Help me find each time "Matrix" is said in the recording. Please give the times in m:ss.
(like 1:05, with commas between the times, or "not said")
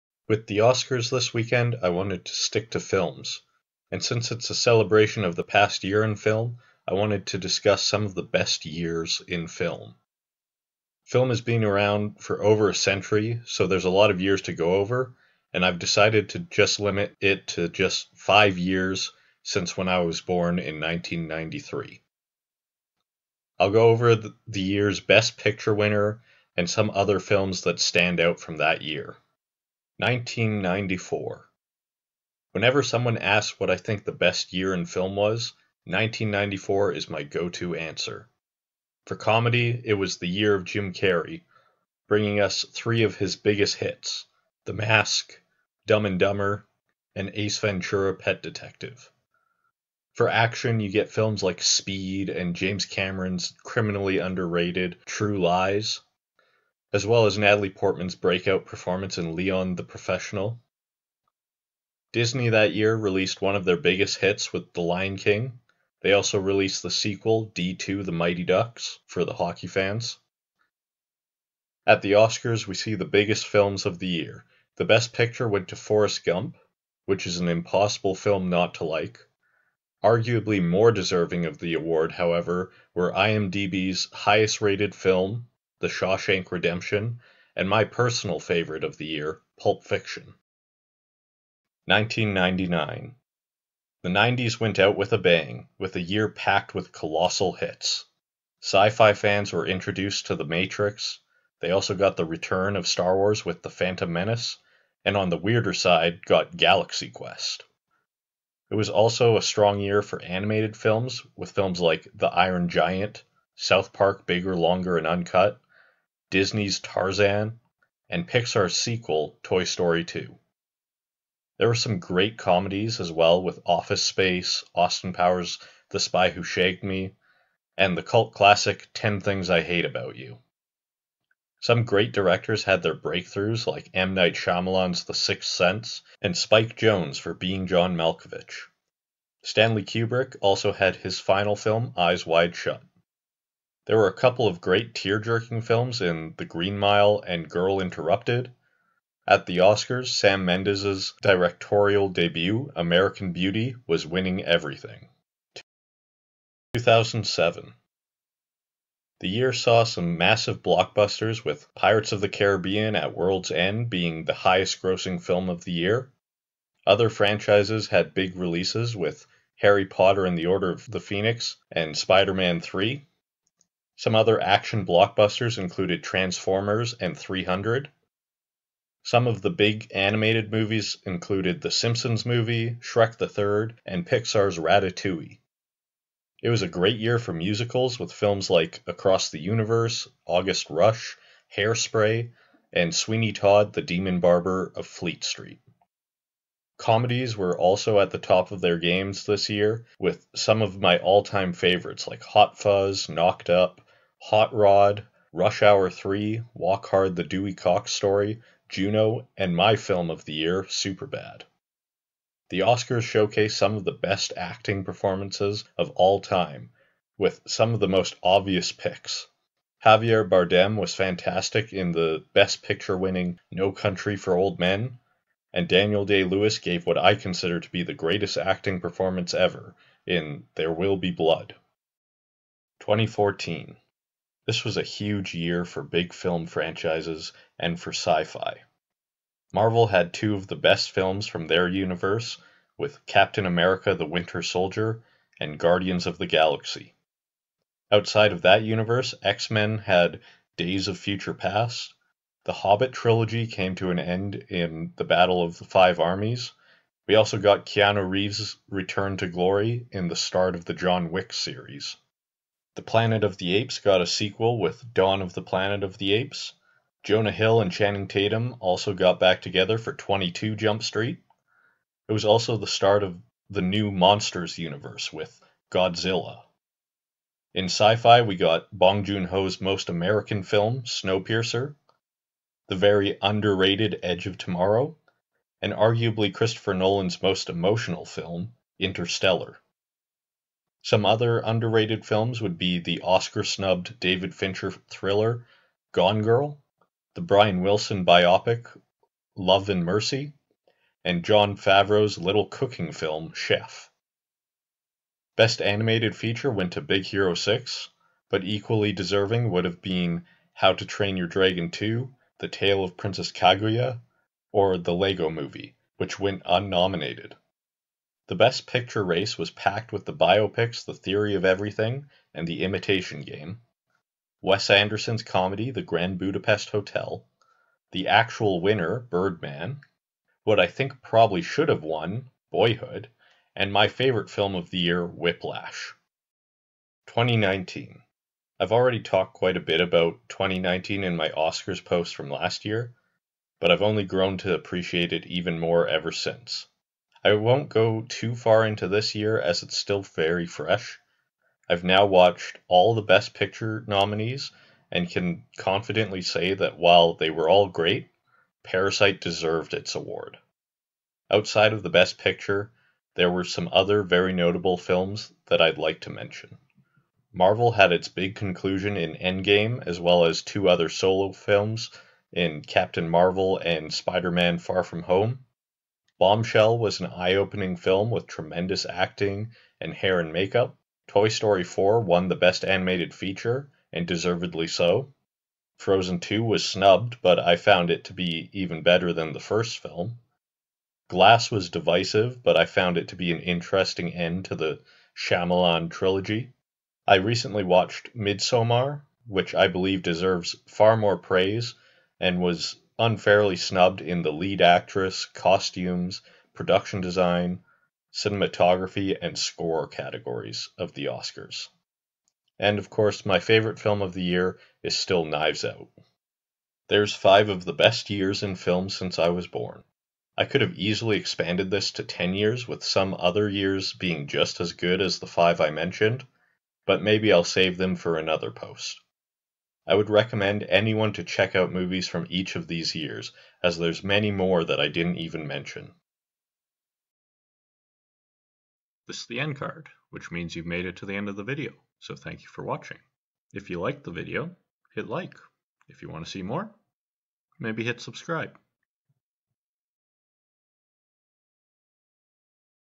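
1:40.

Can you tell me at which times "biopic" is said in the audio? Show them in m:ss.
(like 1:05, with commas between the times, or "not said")
4:58, 5:20.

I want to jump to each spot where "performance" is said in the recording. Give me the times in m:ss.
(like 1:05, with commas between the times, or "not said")
0:58, 3:34, 3:48.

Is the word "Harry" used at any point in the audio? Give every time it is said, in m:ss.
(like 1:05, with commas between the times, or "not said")
2:49.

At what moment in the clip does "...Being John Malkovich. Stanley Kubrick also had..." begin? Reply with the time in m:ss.
2:17.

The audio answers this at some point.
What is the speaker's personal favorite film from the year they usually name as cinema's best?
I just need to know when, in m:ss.
1:29.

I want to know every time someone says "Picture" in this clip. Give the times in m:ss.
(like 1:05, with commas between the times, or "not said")
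0:25, 1:15, 3:42, 5:18, 5:53, 6:02.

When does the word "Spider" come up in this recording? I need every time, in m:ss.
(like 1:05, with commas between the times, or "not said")
2:51, 6:13.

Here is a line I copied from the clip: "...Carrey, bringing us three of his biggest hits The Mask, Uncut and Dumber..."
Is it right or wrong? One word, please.
wrong.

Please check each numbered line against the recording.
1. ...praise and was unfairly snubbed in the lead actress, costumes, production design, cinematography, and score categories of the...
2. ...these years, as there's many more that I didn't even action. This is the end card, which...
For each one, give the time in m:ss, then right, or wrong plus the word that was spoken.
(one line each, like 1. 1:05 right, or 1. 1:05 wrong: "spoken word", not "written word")
1. 6:41 right
2. 7:12 wrong: "mention", not "action".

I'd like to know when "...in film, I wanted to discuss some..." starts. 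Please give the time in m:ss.
0:06.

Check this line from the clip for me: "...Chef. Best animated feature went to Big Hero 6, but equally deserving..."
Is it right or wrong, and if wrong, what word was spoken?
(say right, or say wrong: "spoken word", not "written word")
right.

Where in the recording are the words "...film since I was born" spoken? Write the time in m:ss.
6:58.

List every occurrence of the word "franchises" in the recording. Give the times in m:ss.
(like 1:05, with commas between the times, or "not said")
2:47, 3:56.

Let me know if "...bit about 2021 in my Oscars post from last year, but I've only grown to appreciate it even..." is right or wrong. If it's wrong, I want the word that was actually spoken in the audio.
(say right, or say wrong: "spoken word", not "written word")
wrong: "2019", not "2021".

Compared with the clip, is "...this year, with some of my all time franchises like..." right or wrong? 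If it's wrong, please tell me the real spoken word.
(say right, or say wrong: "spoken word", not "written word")
wrong: "favorites", not "franchises".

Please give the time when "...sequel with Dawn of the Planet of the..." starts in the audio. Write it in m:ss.
4:24.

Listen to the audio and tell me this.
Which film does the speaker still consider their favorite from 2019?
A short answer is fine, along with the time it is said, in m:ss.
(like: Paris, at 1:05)
Knives Out, at 6:55.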